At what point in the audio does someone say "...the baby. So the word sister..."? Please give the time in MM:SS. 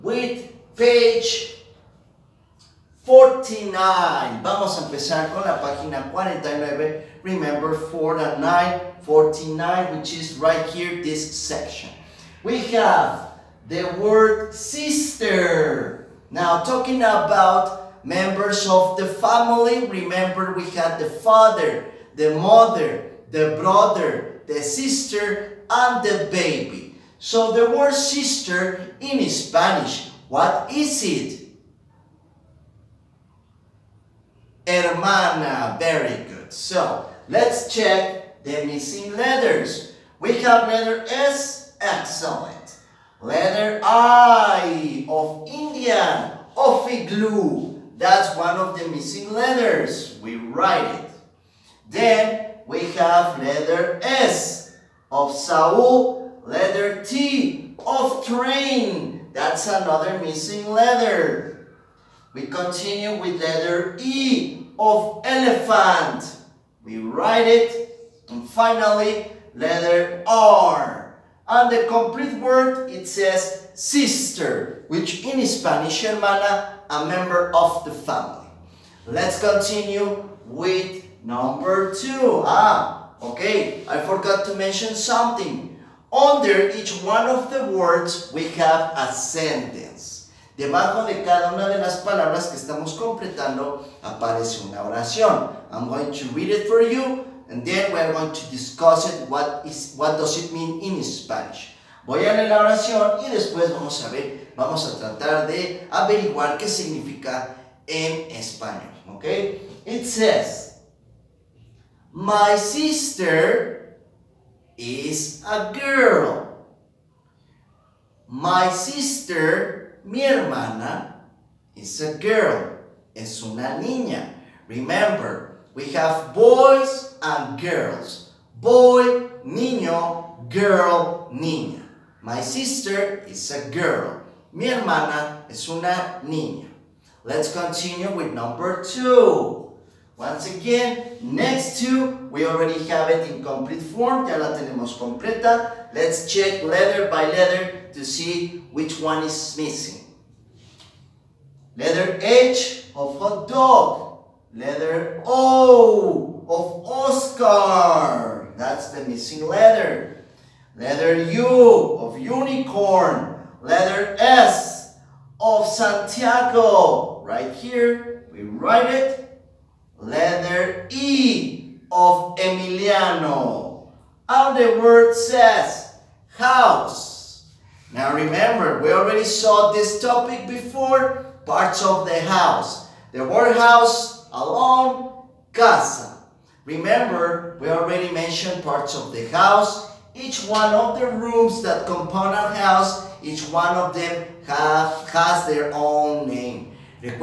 00:26.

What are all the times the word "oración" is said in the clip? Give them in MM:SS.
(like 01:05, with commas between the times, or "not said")
01:34, 01:42.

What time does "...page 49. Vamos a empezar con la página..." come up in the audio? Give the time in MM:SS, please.
00:00.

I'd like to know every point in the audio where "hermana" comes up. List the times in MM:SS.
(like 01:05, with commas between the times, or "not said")
00:34, 01:16, 02:00, 02:14.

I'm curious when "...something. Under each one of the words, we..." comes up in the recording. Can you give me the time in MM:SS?
01:24.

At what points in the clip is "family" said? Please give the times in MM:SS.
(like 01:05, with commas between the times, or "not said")
00:19, 01:17.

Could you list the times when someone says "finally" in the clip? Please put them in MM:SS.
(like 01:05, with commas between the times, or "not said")
01:08.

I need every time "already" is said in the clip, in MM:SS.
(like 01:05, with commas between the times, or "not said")
02:22, 02:58, 03:07.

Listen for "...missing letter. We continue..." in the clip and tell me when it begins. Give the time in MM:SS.
01:00.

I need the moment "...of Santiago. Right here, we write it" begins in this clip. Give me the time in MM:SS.
02:45.